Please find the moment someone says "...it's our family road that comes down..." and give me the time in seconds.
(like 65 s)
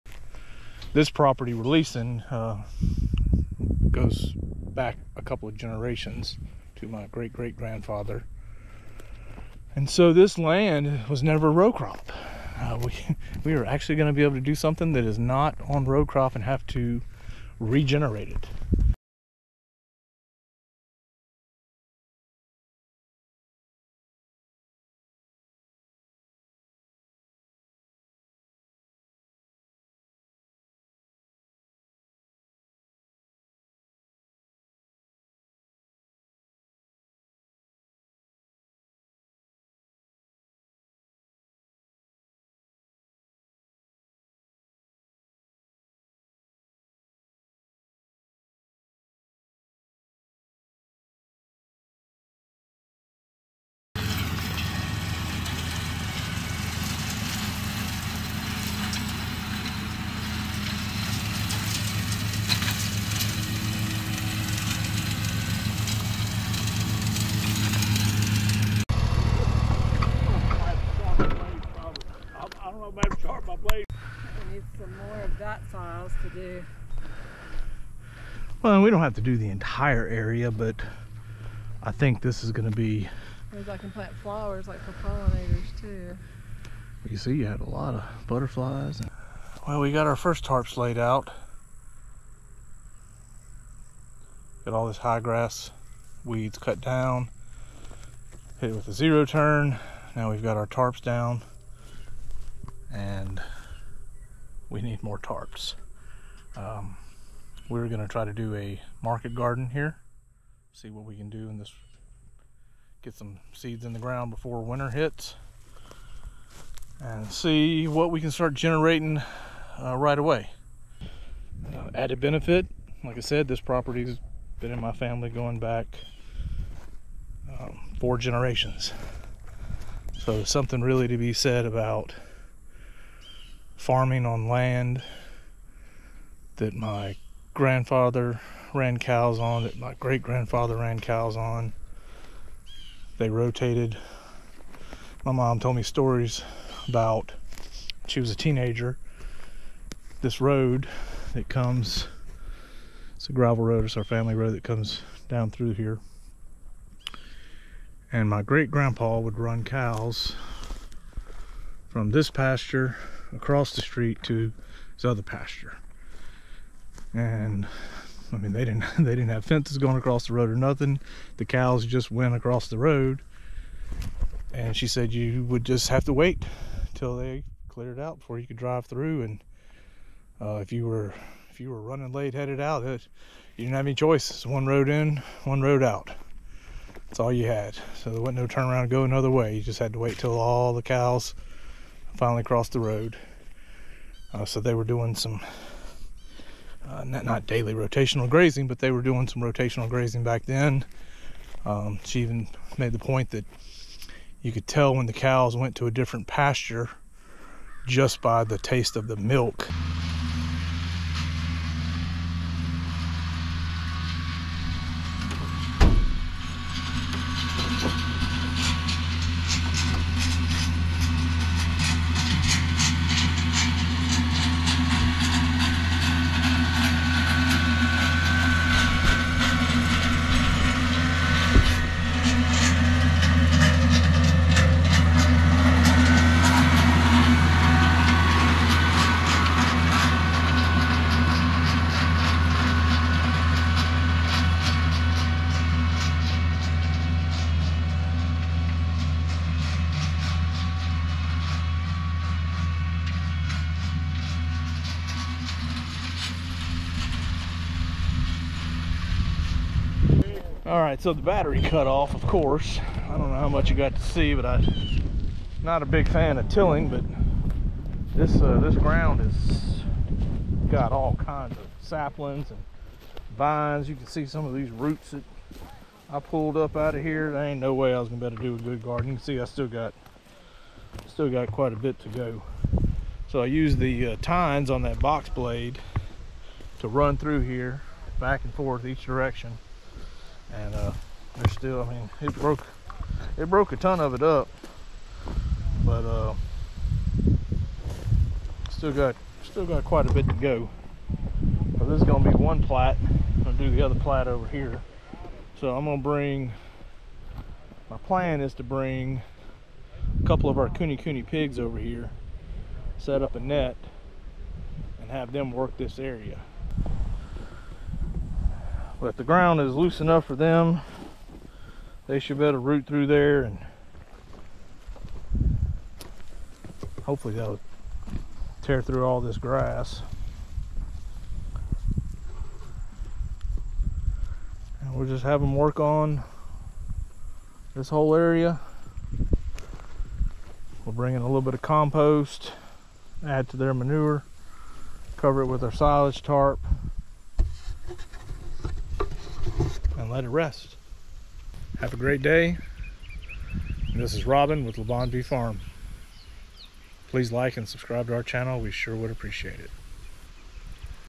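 153 s.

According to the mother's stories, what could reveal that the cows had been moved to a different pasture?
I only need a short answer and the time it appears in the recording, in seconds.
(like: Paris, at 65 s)
taste of the milk, at 208 s.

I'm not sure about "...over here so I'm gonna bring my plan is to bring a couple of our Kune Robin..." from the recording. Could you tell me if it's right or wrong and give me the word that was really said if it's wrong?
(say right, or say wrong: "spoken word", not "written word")
wrong: "Kune", not "Robin".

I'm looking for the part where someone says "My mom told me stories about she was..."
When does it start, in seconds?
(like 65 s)
145 s.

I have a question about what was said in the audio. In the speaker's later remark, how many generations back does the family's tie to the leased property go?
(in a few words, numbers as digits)
4.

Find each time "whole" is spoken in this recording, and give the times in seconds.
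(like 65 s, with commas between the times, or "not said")
337 s.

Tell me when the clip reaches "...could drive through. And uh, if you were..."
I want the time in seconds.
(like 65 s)
178 s.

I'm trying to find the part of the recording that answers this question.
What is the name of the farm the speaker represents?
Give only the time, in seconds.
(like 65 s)
354 s.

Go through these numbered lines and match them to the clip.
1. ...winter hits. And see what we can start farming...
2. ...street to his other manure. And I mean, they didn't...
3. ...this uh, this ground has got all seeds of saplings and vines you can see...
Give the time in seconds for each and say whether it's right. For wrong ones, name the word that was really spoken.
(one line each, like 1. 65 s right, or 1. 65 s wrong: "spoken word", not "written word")
1. 114 s wrong: "generating", not "farming"
2. 163 s wrong: "pasture", not "manure"
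3. 268 s wrong: "kinds", not "seeds".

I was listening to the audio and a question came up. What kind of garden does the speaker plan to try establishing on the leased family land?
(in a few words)
market garden.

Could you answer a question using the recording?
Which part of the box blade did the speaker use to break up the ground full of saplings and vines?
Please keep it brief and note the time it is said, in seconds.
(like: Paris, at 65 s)
tines, at 284 s.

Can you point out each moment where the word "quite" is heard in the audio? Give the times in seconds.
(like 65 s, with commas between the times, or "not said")
281 s, 299 s.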